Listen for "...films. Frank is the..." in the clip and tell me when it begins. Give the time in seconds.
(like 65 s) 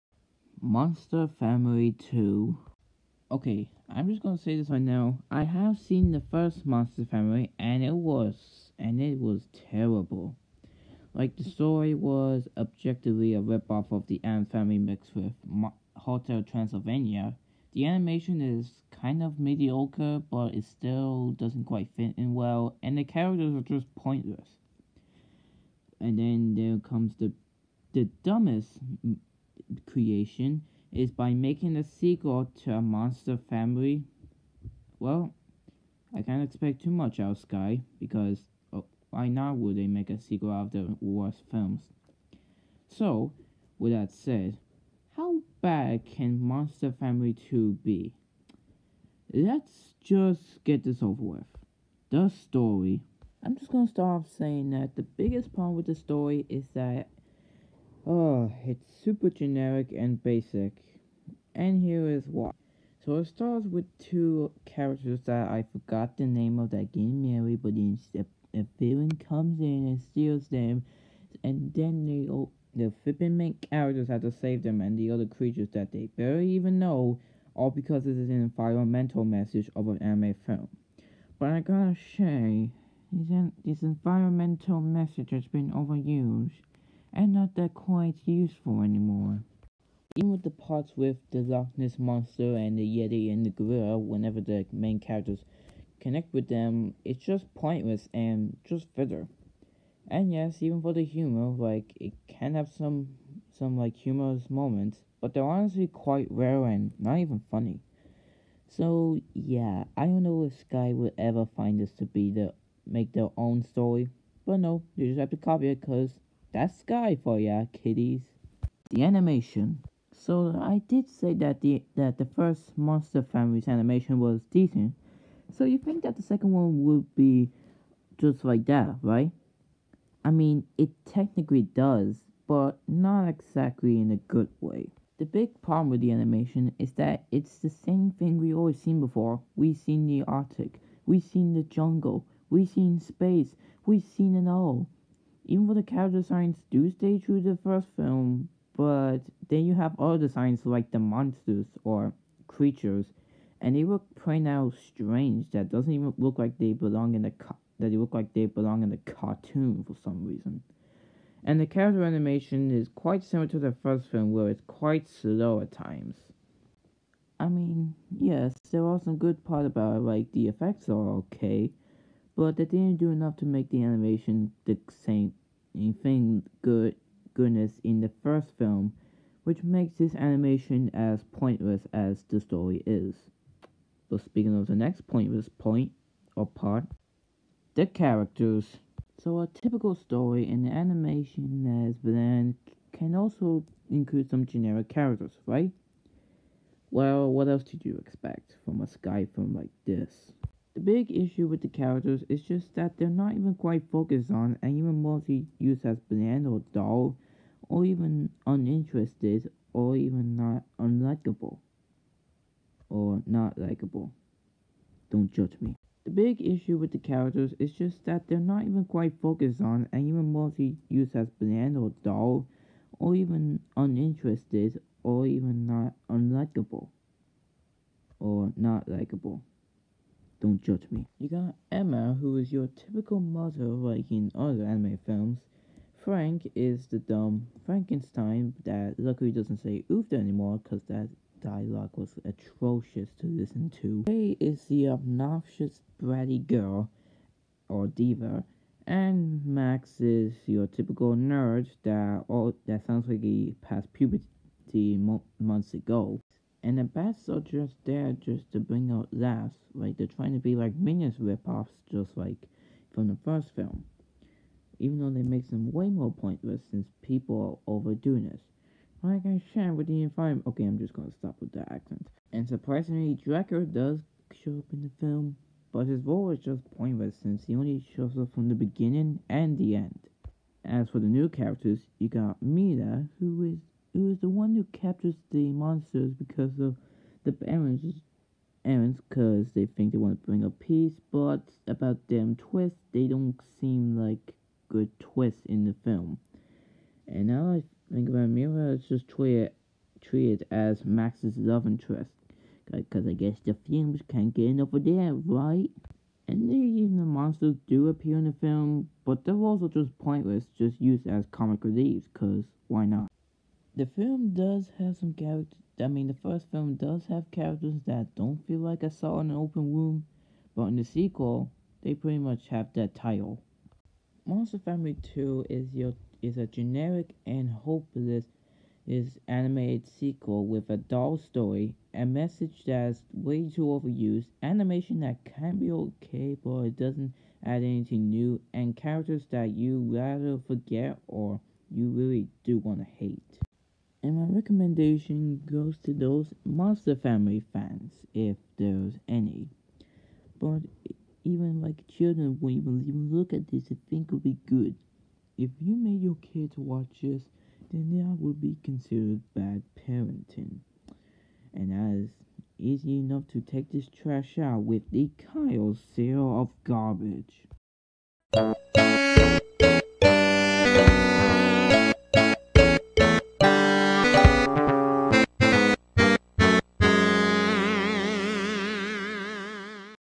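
235 s.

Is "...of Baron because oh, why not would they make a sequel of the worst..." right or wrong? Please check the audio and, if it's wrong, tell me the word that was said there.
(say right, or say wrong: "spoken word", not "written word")
wrong: "Sky", not "Baron".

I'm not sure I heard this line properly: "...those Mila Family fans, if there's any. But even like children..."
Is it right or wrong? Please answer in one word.
wrong.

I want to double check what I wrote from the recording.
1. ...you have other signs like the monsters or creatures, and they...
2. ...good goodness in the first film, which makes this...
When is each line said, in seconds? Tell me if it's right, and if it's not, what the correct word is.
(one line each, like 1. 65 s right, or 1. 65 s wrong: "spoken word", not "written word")
1. 149 s right
2. 176 s right.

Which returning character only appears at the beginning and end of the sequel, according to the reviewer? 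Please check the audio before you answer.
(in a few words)
Draco.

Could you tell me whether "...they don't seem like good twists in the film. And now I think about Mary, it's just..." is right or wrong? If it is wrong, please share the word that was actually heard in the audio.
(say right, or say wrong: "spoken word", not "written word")
wrong: "Mira", not "Mary".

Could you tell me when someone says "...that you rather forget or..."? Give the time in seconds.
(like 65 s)
339 s.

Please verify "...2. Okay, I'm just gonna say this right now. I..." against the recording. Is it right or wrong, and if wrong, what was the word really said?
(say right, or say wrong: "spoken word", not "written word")
right.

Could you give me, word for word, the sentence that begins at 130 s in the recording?
I mean, it technically does, but not exactly in a good way.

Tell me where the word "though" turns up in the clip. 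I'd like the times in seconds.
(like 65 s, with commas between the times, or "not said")
145 s, 264 s.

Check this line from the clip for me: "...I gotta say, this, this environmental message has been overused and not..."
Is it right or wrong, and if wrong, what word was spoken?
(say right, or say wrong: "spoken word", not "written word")
right.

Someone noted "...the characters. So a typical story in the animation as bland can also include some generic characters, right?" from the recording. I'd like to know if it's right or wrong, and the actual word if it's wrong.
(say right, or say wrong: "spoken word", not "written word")
right.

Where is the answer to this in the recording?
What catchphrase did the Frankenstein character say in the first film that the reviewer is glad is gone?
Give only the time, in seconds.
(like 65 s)
239 s.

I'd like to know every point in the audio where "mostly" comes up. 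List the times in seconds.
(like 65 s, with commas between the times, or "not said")
205 s, 220 s.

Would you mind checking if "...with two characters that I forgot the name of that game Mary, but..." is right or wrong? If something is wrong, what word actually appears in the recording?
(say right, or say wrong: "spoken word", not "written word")
right.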